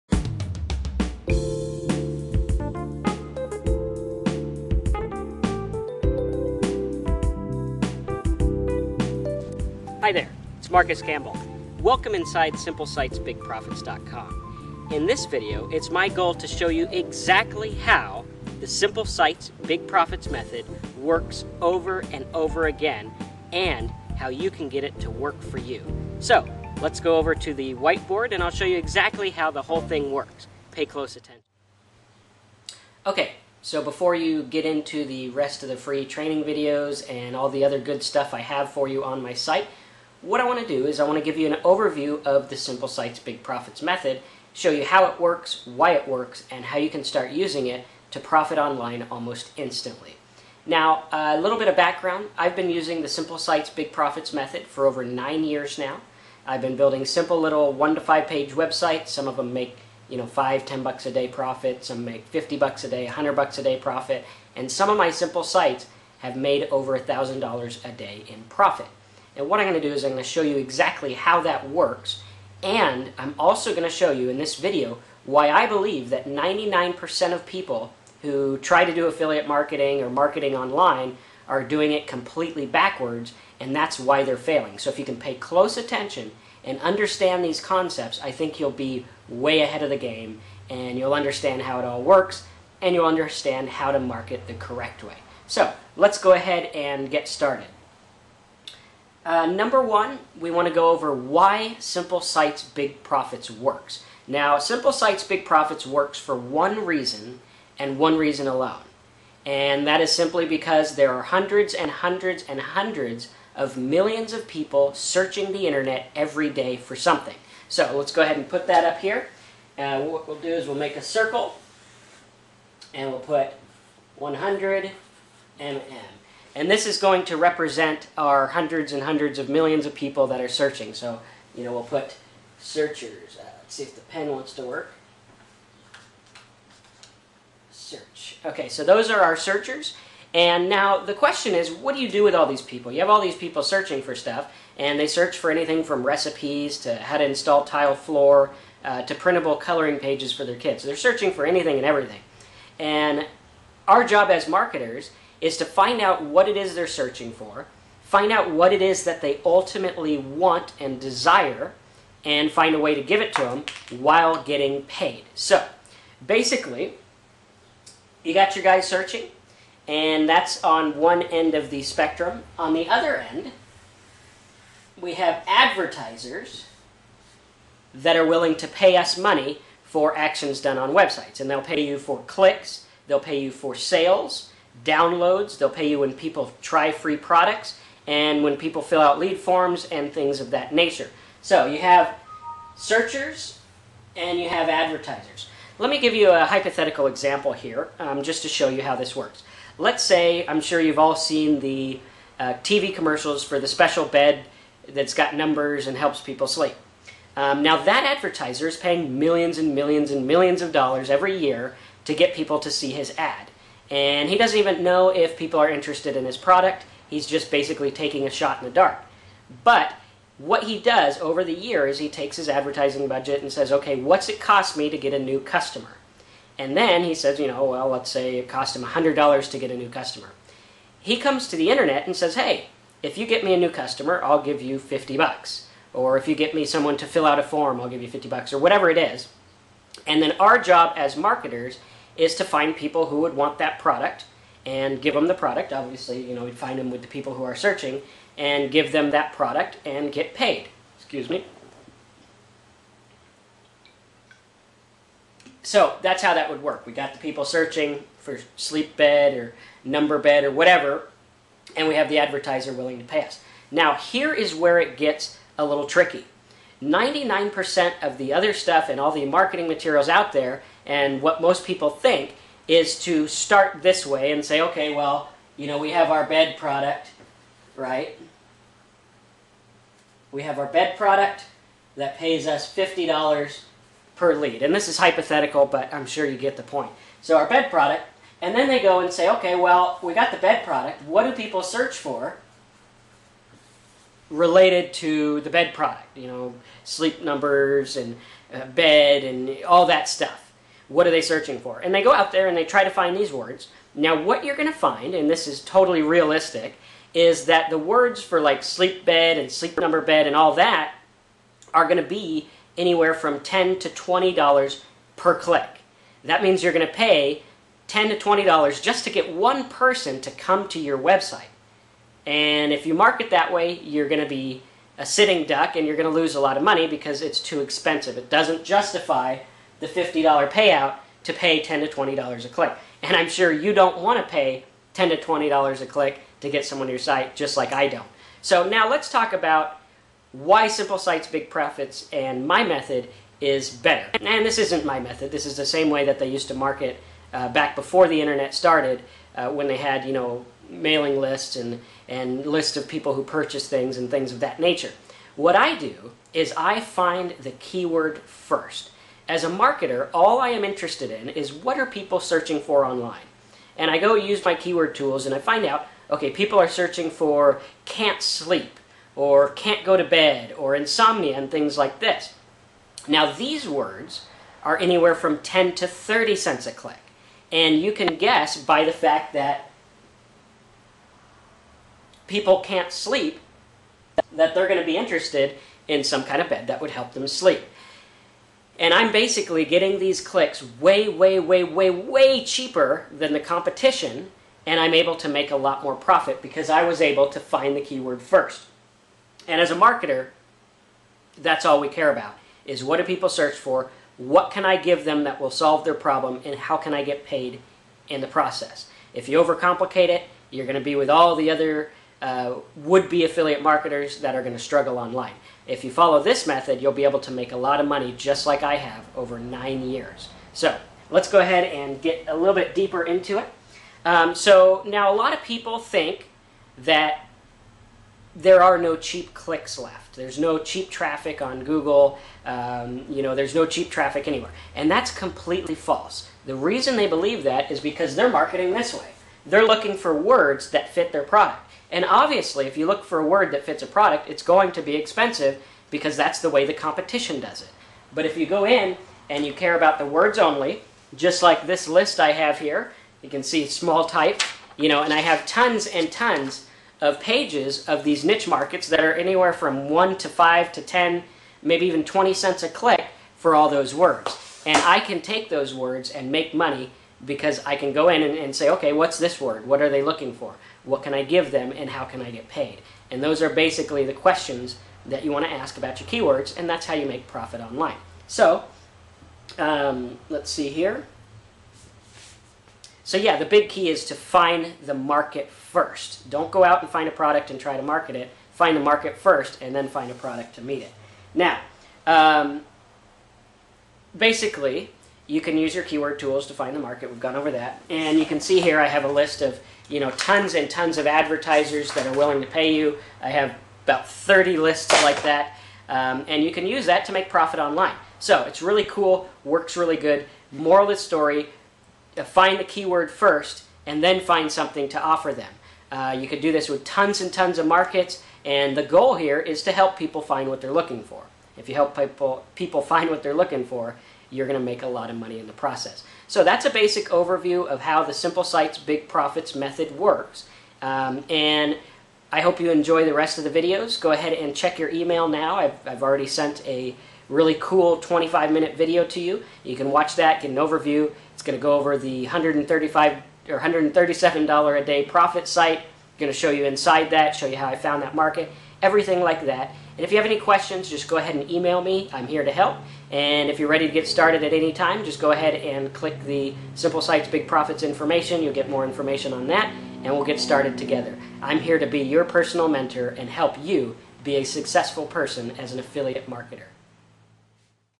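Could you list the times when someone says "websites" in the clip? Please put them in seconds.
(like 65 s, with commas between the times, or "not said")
58 s, 180 s, 320 s.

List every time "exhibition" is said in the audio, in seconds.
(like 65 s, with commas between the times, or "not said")
not said.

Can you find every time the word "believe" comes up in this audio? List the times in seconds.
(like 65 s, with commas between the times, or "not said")
75 s, 437 s.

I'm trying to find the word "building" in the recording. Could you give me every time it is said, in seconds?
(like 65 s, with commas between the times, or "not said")
56 s.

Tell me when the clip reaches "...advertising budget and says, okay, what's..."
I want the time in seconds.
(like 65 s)
222 s.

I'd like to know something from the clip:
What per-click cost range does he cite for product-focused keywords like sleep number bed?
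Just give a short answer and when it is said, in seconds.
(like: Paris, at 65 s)
$10 to $20, at 313 s.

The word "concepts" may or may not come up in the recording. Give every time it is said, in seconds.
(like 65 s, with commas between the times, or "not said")
87 s.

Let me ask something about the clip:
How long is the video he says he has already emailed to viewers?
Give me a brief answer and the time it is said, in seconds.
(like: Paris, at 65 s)
25 minutes, at 537 s.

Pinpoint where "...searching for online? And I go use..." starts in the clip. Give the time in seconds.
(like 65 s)
362 s.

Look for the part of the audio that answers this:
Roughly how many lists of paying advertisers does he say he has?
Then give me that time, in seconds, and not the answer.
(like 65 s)
503 s.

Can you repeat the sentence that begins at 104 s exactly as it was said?
Now, Simple Sites Big Profits works for one reason and one reason alone.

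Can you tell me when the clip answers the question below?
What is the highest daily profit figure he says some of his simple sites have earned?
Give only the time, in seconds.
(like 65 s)
66 s.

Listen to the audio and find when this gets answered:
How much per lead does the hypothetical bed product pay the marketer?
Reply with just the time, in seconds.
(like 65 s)
282 s.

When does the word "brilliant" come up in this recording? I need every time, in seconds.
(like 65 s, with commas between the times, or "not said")
not said.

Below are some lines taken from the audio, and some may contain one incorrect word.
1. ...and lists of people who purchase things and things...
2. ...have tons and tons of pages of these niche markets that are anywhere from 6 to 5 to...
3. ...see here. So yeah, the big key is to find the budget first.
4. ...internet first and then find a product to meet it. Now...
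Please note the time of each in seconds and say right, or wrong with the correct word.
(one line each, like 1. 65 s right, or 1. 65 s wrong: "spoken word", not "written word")
1. 352 s right
2. 455 s wrong: "1", not "6"
3. 480 s wrong: "market", not "budget"
4. 488 s wrong: "market", not "internet".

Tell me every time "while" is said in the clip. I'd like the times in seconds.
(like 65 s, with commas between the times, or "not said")
163 s.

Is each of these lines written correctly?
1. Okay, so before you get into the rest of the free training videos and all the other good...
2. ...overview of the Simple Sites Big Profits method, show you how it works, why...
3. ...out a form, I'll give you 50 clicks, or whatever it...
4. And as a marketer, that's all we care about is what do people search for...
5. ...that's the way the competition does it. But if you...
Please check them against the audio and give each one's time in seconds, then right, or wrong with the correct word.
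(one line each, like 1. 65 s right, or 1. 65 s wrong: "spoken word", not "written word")
1. 33 s right
2. 41 s right
3. 237 s wrong: "bucks", not "clicks"
4. 399 s right
5. 446 s right.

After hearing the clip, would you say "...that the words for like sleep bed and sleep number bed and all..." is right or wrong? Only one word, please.
right.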